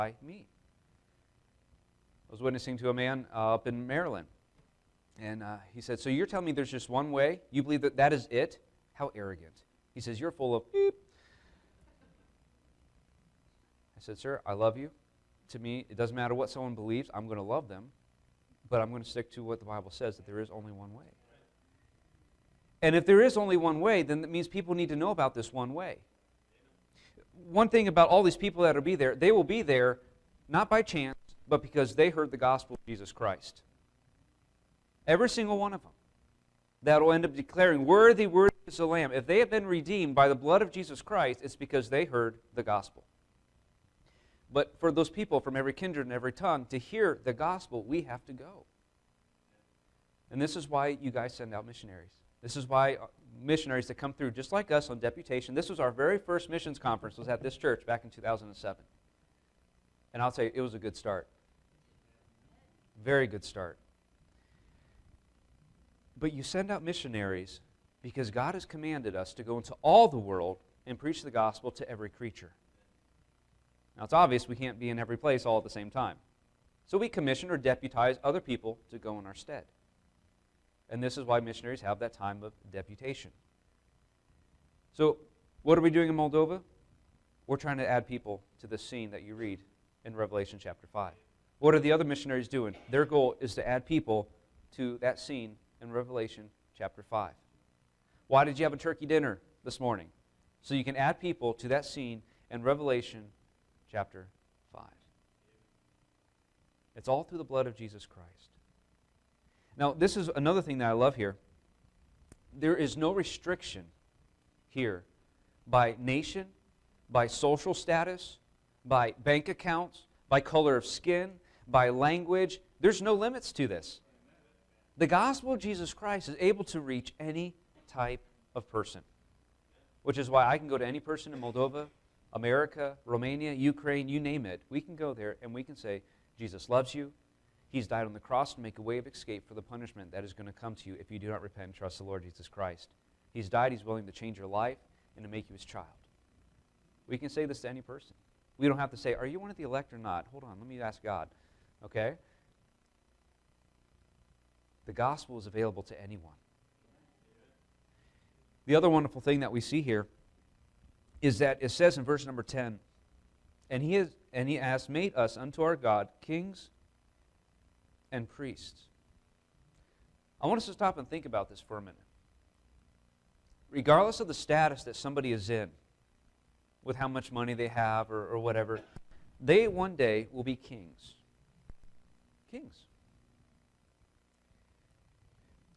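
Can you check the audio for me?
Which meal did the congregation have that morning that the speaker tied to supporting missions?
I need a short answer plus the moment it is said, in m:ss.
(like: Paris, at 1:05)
turkey dinner, at 1:38.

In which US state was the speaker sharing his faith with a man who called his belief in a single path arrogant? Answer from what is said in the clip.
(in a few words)
Maryland.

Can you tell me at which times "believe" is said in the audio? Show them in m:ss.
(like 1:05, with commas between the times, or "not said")
0:07, 0:16.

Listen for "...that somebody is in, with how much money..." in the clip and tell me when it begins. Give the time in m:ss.
2:54.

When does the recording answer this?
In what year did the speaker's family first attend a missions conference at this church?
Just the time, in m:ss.
0:58.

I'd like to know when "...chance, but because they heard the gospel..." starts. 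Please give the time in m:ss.
0:30.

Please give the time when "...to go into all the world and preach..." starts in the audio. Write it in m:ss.
1:09.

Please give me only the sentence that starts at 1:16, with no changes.
So we commission or deputize other people to go in our stead.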